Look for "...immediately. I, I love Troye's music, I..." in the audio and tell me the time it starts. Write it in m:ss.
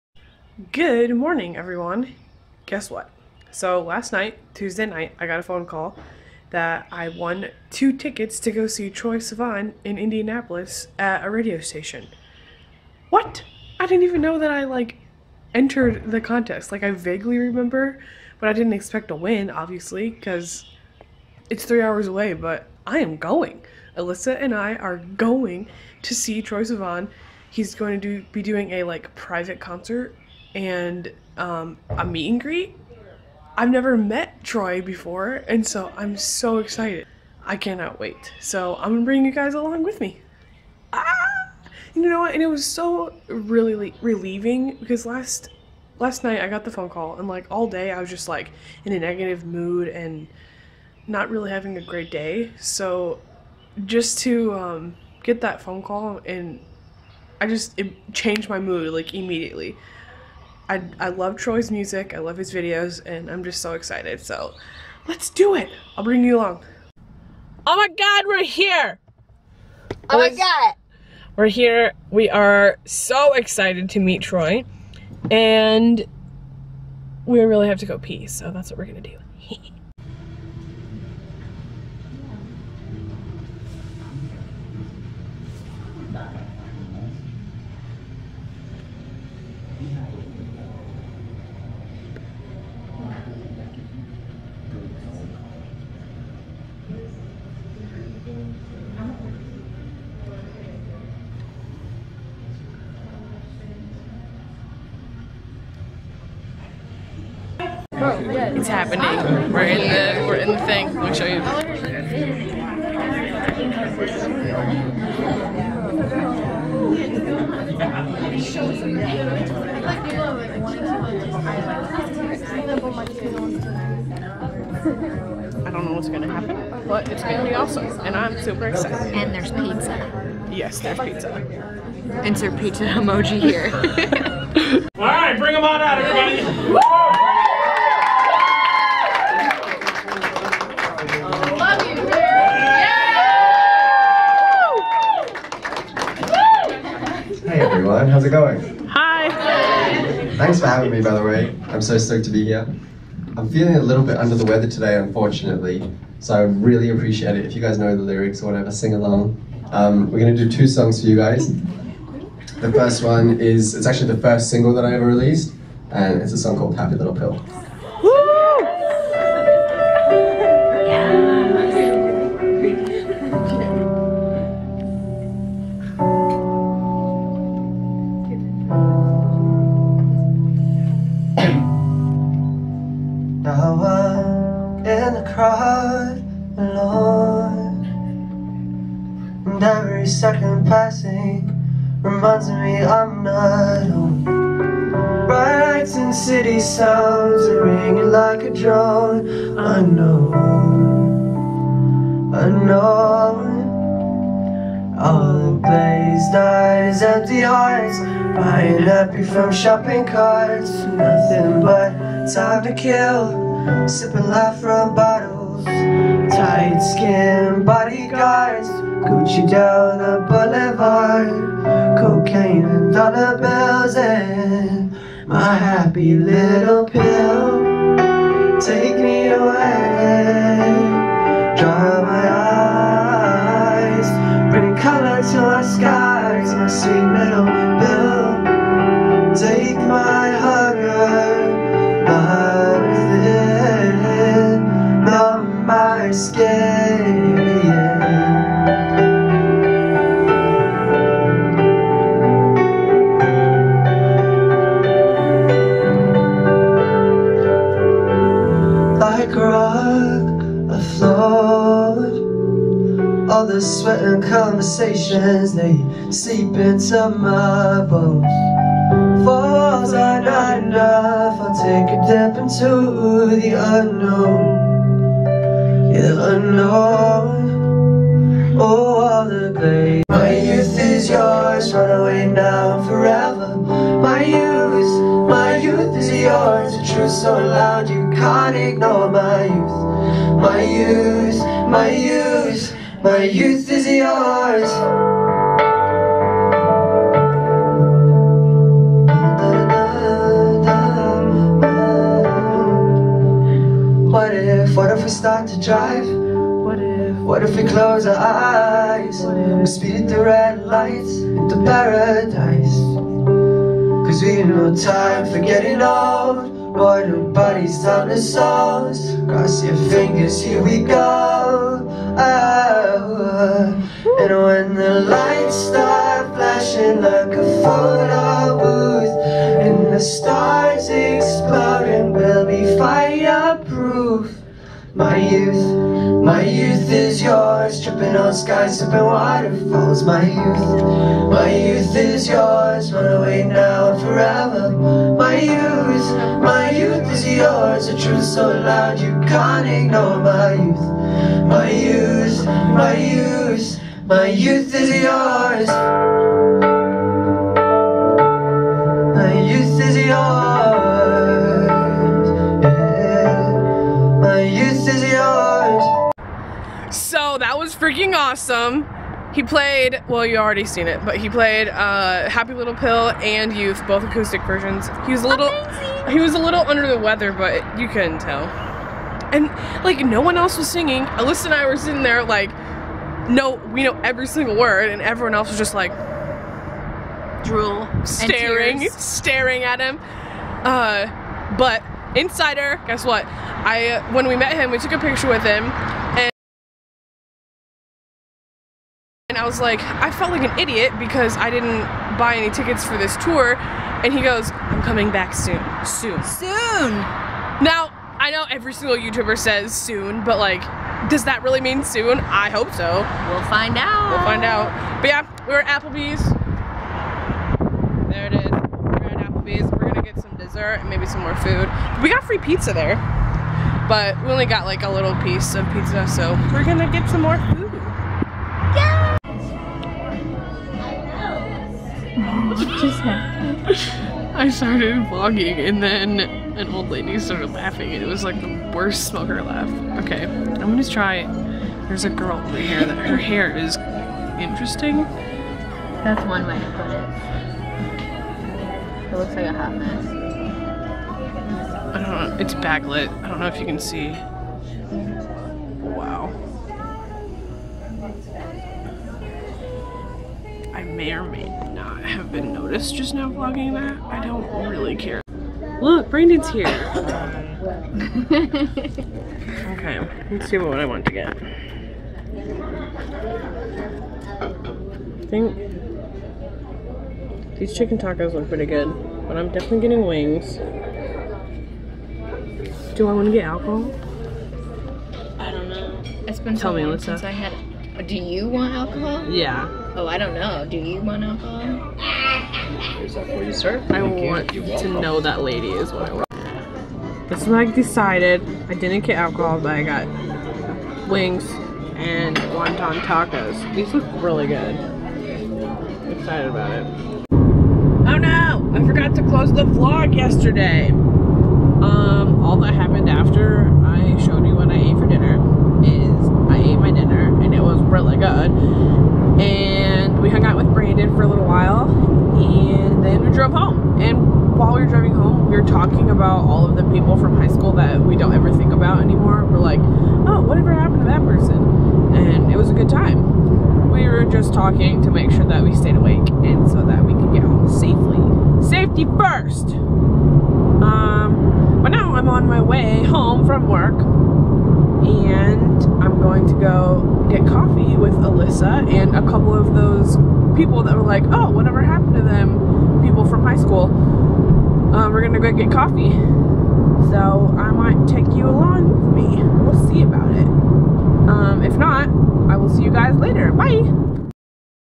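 0:59.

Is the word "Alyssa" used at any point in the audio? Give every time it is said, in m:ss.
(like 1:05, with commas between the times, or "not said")
0:23, 6:21, 8:06, 9:08.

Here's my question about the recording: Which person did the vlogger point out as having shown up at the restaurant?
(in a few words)
Brandon.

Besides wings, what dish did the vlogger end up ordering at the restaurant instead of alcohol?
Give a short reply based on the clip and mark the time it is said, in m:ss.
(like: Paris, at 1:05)
Wonton tacos, at 8:22.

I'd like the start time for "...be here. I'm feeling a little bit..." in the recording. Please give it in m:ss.
2:32.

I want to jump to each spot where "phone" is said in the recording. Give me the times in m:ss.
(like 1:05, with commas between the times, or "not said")
0:05, 0:46, 0:55.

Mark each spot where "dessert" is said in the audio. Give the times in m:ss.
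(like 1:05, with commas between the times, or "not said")
7:00.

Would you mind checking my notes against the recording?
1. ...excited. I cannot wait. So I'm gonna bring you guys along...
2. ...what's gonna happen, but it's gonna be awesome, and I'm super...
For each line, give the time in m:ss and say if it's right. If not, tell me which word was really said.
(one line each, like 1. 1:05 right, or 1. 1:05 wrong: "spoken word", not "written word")
1. 0:36 right
2. 2:05 right.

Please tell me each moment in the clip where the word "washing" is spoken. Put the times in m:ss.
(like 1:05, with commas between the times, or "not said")
not said.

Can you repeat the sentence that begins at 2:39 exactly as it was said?
Um, we're going to do two songs for you guys.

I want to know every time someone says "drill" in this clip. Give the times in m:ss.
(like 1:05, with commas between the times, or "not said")
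not said.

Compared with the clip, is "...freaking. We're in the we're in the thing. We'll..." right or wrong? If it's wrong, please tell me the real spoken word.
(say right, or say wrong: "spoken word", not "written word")
wrong: "happening", not "freaking".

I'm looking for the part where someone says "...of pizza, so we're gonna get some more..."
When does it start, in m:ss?
7:05.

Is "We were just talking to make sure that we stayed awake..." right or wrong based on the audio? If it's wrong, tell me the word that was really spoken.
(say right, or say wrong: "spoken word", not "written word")
right.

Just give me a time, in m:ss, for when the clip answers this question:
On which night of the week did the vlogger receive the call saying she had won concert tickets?
0:04.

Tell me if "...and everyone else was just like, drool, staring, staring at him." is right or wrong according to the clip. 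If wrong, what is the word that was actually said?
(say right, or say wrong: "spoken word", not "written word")
right.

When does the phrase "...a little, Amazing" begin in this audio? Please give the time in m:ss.
6:15.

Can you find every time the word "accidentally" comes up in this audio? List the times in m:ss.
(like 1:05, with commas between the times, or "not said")
not said.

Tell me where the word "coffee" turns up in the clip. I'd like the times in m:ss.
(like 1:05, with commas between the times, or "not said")
9:07, 9:15.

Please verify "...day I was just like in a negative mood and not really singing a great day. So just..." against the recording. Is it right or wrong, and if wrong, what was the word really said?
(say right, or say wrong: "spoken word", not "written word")
wrong: "having", not "singing".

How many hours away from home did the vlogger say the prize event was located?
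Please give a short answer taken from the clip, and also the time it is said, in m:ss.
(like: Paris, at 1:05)
3, at 0:21.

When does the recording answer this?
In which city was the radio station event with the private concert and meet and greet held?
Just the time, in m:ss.
0:09.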